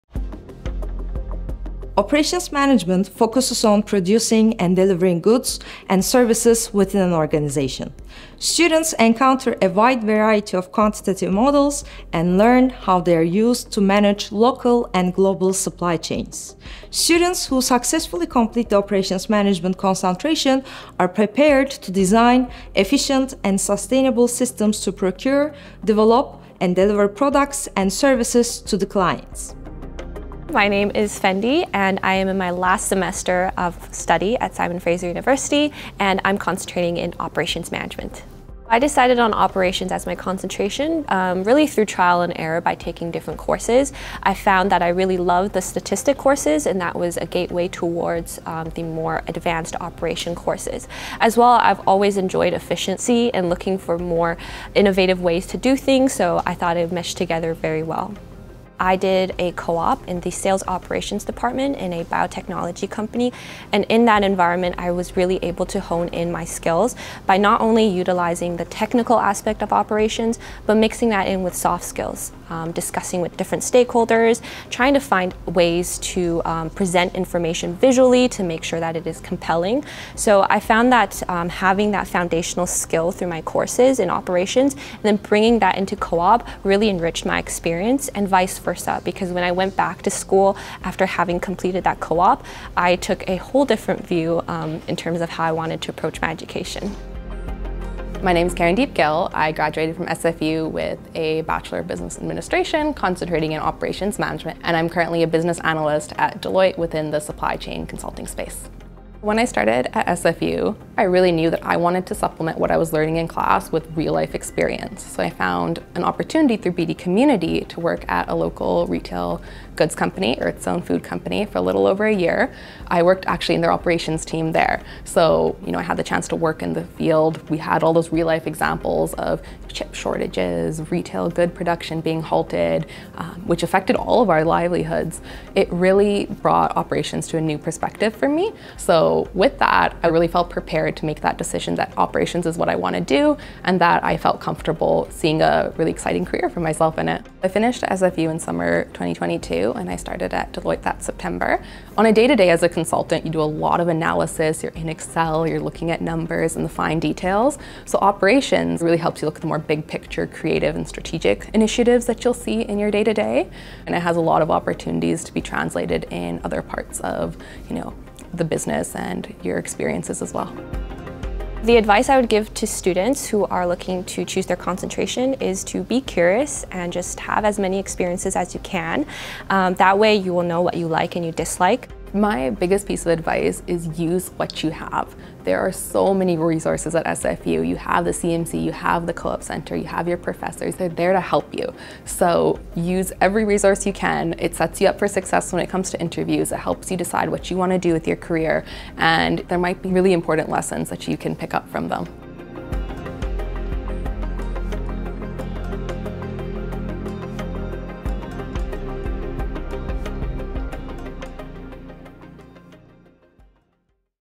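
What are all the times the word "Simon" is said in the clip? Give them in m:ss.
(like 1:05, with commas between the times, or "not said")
0:34.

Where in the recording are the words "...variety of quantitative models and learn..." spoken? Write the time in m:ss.
0:10.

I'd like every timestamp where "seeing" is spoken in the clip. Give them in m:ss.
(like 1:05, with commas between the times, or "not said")
2:25.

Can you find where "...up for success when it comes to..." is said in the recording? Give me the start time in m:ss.
3:14.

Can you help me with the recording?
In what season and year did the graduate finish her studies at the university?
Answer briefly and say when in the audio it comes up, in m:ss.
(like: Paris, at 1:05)
Summer 2022, at 2:28.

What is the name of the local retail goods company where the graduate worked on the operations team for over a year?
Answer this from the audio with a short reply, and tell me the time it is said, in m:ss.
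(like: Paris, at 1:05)
Earth's Own Food Company, at 2:00.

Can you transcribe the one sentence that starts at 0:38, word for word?
I decided on operations as my concentration, um, really through trial and error by taking different courses.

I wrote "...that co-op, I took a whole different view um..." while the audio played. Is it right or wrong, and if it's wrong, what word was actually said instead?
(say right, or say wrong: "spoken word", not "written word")
right.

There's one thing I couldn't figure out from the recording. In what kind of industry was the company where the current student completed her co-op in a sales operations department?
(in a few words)
Biotechnology.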